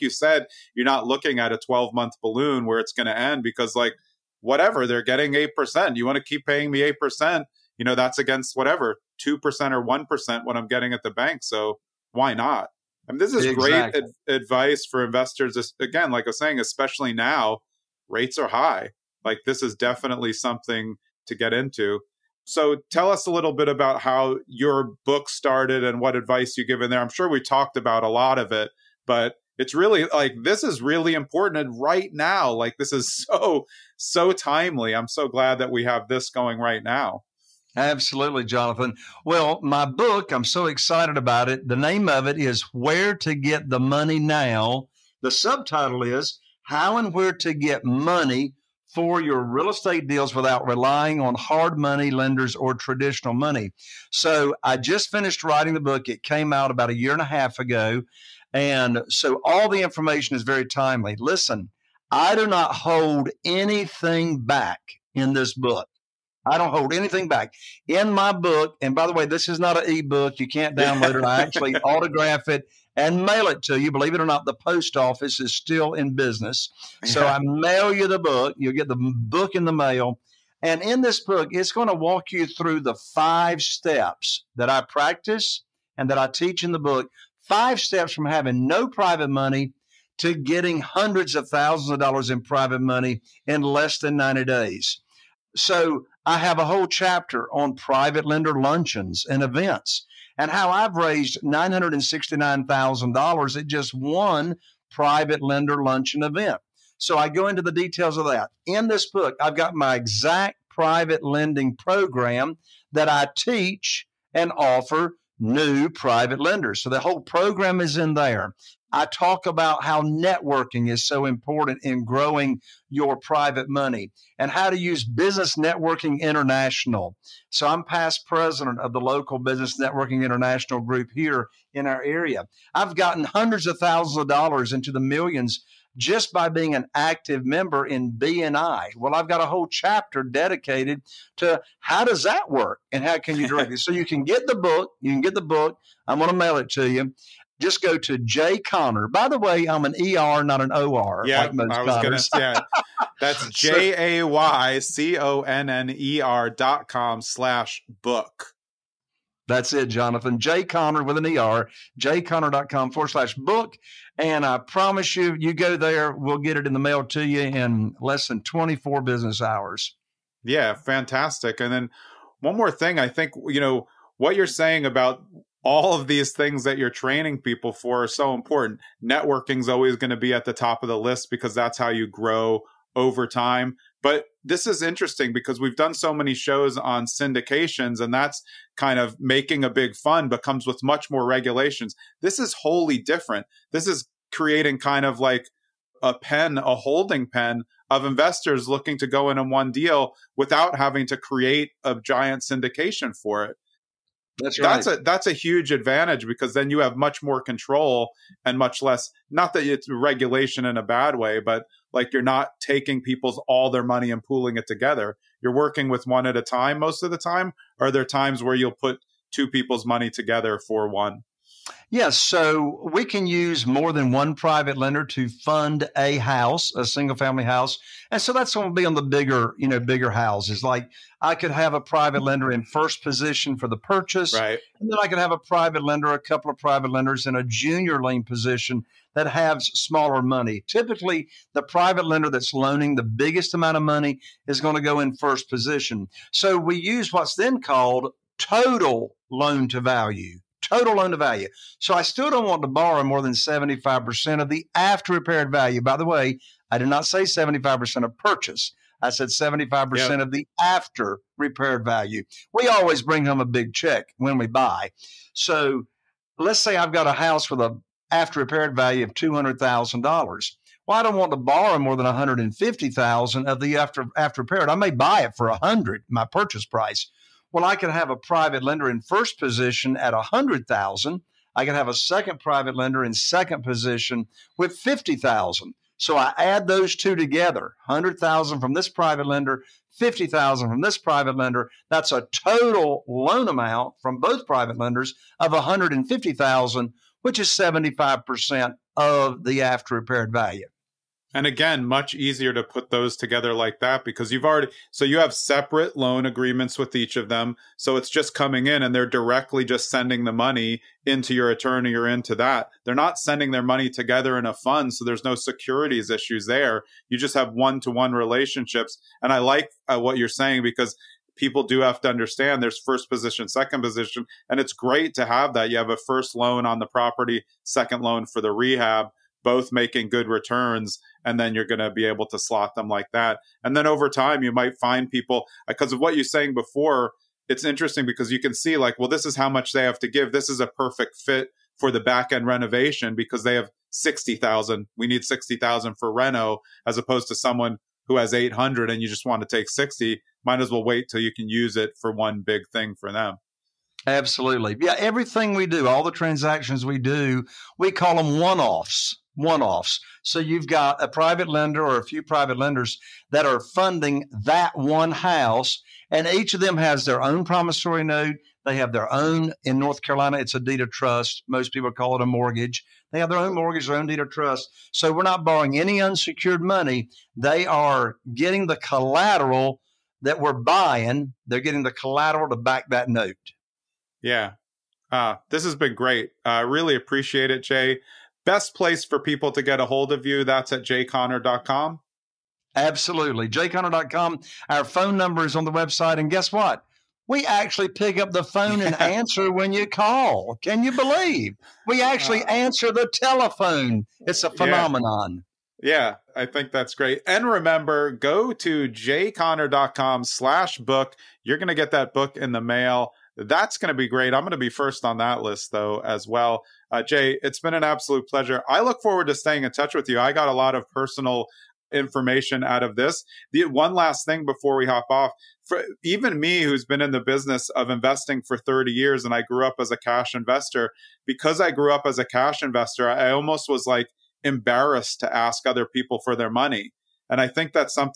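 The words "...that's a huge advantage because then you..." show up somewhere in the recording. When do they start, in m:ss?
3:25.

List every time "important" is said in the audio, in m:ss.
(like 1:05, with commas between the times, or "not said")
0:31, 2:01, 2:58.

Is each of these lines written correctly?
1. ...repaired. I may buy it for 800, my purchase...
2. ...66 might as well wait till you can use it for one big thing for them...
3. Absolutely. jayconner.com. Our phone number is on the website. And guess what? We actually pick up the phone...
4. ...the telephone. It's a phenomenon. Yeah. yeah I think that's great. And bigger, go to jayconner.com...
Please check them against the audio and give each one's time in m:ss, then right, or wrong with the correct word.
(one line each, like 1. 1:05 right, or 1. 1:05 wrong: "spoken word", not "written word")
1. 4:34 wrong: "100", not "800"
2. 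5:49 wrong: "60", not "66"
3. 6:32 right
4. 6:42 wrong: "remember", not "bigger".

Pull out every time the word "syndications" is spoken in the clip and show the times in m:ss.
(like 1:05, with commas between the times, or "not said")
3:07, 3:22.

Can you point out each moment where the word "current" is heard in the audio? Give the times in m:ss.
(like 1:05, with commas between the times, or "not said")
not said.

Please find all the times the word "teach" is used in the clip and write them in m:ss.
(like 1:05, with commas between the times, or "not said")
1:26, 1:53.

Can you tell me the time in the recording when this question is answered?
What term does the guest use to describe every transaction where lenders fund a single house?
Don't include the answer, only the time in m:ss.
5:58.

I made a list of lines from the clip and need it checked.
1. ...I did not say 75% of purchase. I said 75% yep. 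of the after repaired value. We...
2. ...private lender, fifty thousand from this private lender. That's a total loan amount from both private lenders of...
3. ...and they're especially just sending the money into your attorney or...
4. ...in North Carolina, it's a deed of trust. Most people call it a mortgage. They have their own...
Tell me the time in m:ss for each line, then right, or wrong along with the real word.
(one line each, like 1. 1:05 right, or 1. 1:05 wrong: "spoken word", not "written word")
1. 4:16 right
2. 4:48 right
3. 5:08 wrong: "directly", not "especially"
4. 6:09 right.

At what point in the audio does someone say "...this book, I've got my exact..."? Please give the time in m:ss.
1:48.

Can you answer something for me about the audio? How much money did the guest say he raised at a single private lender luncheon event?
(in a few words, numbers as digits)
$969,000.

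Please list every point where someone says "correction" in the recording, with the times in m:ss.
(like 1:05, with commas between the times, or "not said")
not said.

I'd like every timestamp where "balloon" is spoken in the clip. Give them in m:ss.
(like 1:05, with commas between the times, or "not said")
0:02.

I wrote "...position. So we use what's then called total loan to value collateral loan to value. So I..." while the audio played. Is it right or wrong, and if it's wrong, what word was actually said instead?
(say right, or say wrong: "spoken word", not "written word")
wrong: "total", not "collateral".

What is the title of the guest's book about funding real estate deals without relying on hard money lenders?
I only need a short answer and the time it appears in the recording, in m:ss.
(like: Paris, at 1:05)
Where to Get the Money Now, at 0:42.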